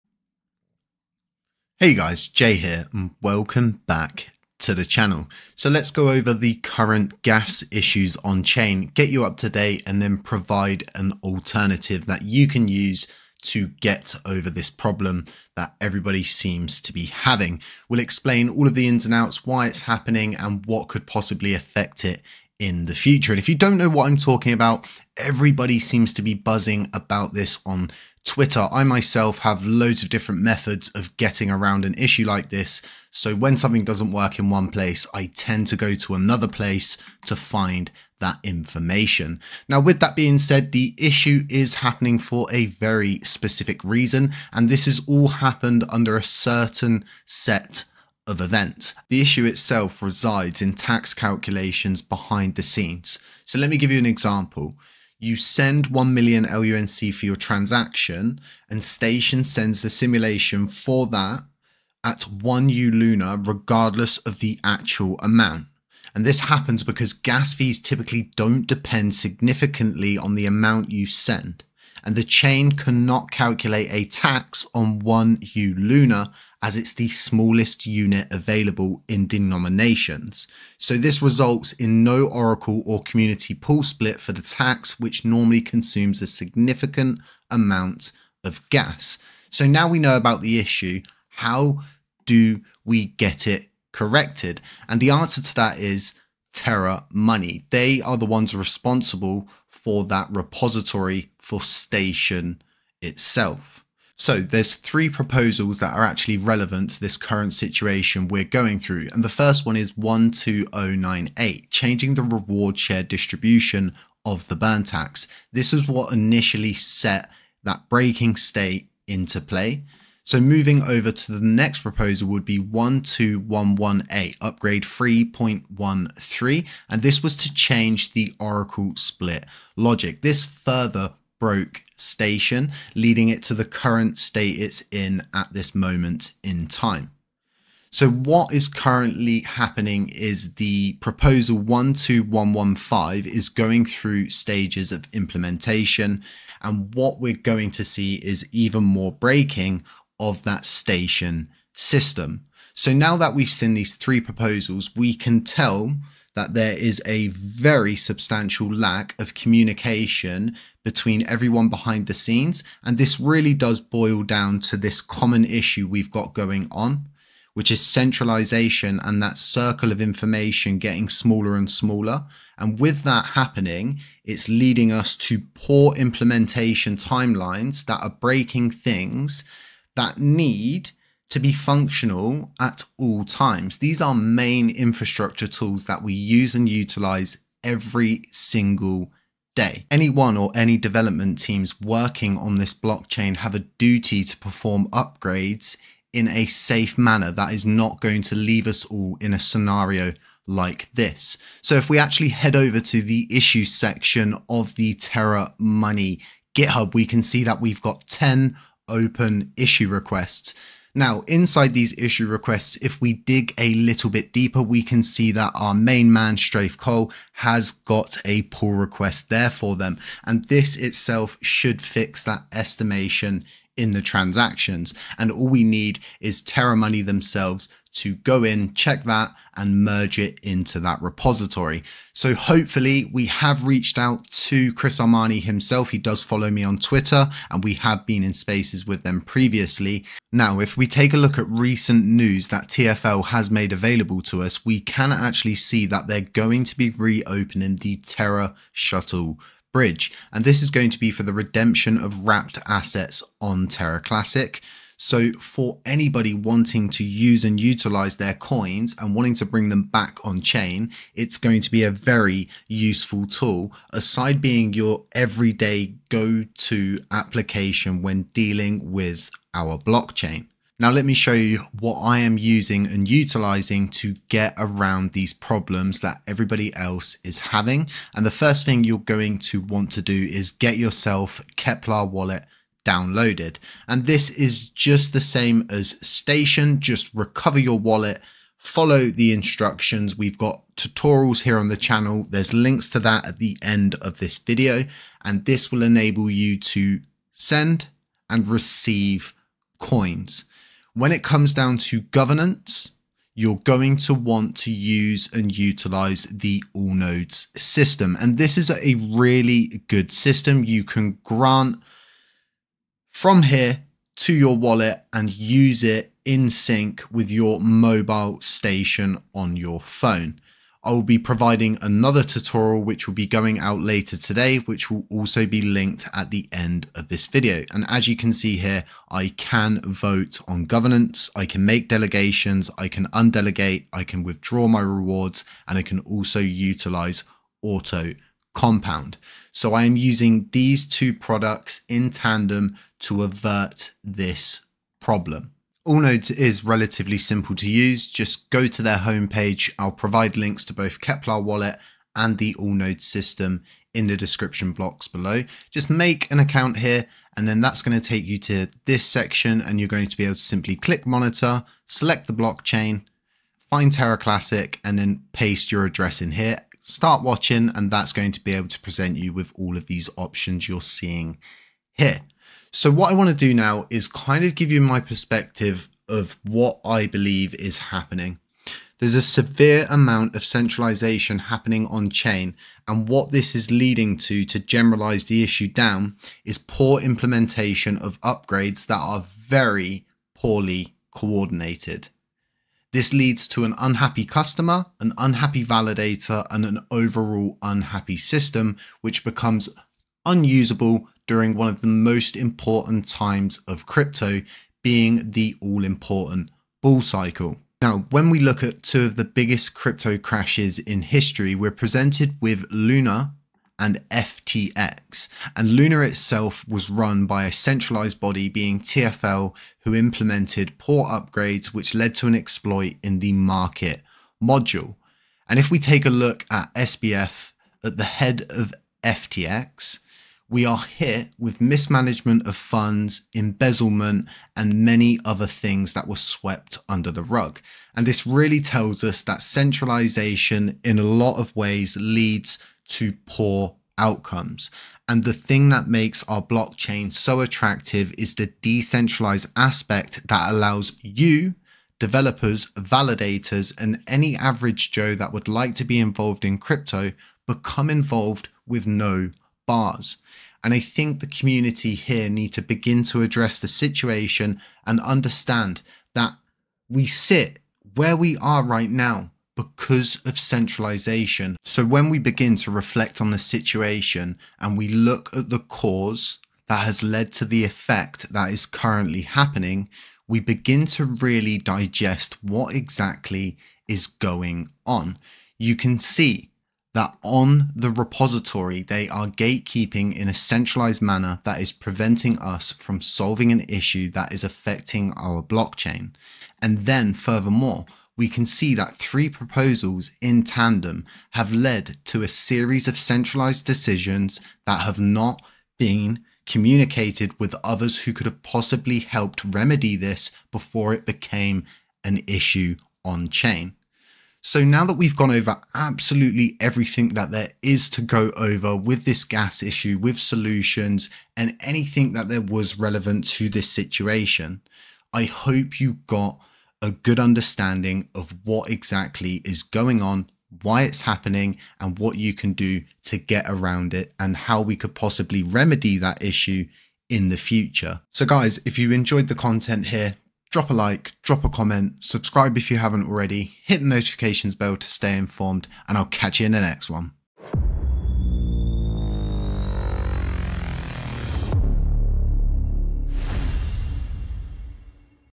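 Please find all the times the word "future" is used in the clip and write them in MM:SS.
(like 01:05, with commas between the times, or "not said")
00:22, 08:57.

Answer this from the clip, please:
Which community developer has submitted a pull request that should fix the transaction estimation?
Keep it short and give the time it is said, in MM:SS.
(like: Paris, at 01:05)
StrathCole, at 03:36.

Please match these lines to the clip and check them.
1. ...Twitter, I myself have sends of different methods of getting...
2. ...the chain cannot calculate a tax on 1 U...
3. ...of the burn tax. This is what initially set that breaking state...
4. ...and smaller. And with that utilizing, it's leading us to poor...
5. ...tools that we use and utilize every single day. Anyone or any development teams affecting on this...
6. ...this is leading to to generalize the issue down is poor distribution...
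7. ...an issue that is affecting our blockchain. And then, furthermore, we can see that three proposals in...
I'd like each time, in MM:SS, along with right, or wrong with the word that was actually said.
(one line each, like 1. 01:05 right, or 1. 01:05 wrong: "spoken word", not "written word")
1. 00:28 wrong: "loads", not "sends"
2. 01:12 right
3. 01:54 right
4. 02:51 wrong: "happening", not "utilizing"
5. 03:05 wrong: "working", not "affecting"
6. 06:23 wrong: "implementation", not "distribution"
7. 08:13 right.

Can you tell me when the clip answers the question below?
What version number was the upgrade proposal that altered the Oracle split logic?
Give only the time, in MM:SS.
02:04.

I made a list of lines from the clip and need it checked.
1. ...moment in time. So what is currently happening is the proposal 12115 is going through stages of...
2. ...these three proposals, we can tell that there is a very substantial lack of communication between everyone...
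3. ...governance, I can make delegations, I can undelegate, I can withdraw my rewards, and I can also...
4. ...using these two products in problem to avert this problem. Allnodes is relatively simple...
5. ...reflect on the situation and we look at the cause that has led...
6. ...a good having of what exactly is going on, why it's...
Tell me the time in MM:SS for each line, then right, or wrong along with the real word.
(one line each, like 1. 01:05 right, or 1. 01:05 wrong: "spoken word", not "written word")
1. 02:15 right
2. 02:33 right
3. 05:30 right
4. 05:39 wrong: "tandem", not "problem"
5. 07:52 right
6. 08:46 wrong: "understanding", not "having".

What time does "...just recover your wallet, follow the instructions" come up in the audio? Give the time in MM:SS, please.
04:46.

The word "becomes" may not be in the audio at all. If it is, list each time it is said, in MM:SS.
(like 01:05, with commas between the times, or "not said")
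06:39, 07:37.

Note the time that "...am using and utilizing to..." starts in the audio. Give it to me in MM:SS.
04:32.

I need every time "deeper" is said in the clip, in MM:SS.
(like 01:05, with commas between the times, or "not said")
03:34.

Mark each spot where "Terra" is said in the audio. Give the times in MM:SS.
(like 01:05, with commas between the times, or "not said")
01:36, 03:24, 03:46, 04:07, 04:13, 06:03.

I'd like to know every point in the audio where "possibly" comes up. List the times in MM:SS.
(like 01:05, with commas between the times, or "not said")
00:21, 08:28, 08:54.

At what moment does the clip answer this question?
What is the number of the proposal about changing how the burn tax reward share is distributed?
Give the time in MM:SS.
01:49.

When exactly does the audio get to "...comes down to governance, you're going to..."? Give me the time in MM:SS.
05:01.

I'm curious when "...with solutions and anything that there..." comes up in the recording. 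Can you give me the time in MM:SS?
08:39.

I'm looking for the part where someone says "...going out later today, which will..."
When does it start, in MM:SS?
05:23.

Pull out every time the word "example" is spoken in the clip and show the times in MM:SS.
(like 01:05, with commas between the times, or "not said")
00:54.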